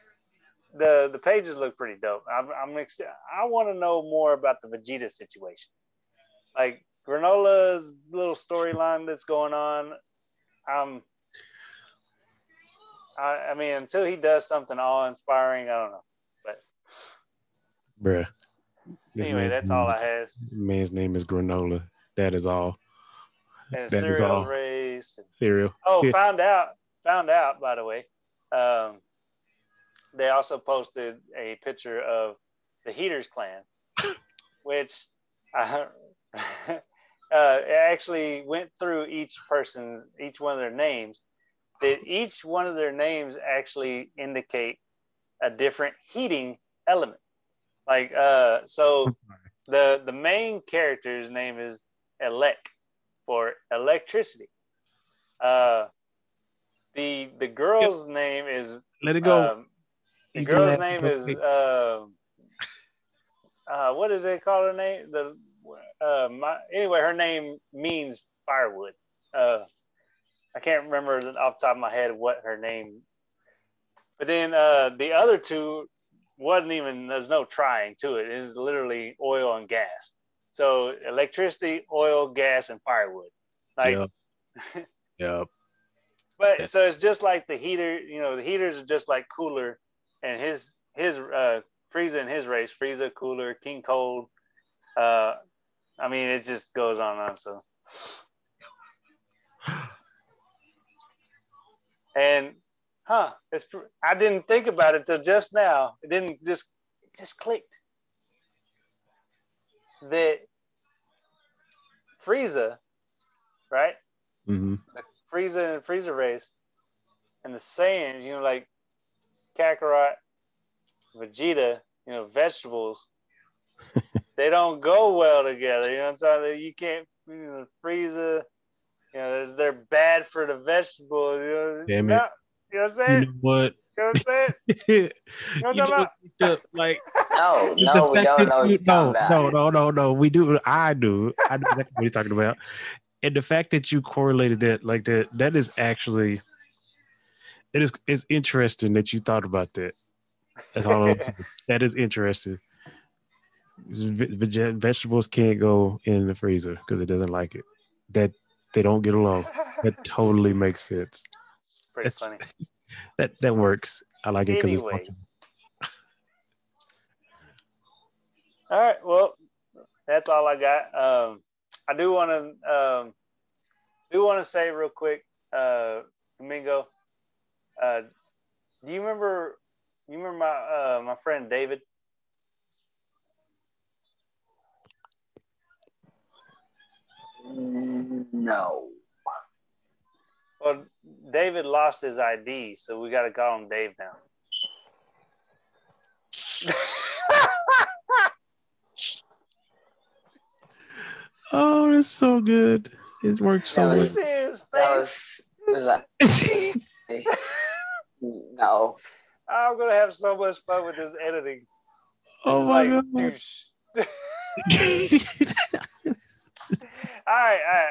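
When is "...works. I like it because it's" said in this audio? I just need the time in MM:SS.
02:43.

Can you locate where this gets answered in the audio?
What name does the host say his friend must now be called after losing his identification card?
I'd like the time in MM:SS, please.
03:13.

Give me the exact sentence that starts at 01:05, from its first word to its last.
The uh, my, anyway, her name means firewood.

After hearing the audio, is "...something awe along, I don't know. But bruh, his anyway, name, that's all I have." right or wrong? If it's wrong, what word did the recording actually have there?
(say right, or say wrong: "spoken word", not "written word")
wrong: "inspiring", not "along".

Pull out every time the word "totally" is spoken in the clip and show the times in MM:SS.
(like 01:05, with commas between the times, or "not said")
02:40.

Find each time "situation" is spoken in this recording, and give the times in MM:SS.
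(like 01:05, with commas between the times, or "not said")
00:05.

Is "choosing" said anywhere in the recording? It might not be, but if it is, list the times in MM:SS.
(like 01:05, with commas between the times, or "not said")
not said.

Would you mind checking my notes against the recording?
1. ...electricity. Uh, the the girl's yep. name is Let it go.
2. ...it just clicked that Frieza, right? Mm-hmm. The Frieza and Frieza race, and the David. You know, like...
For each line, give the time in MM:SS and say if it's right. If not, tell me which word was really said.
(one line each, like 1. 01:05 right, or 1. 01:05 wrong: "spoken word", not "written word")
1. 00:53 right
2. 01:47 wrong: "Saiyans", not "David".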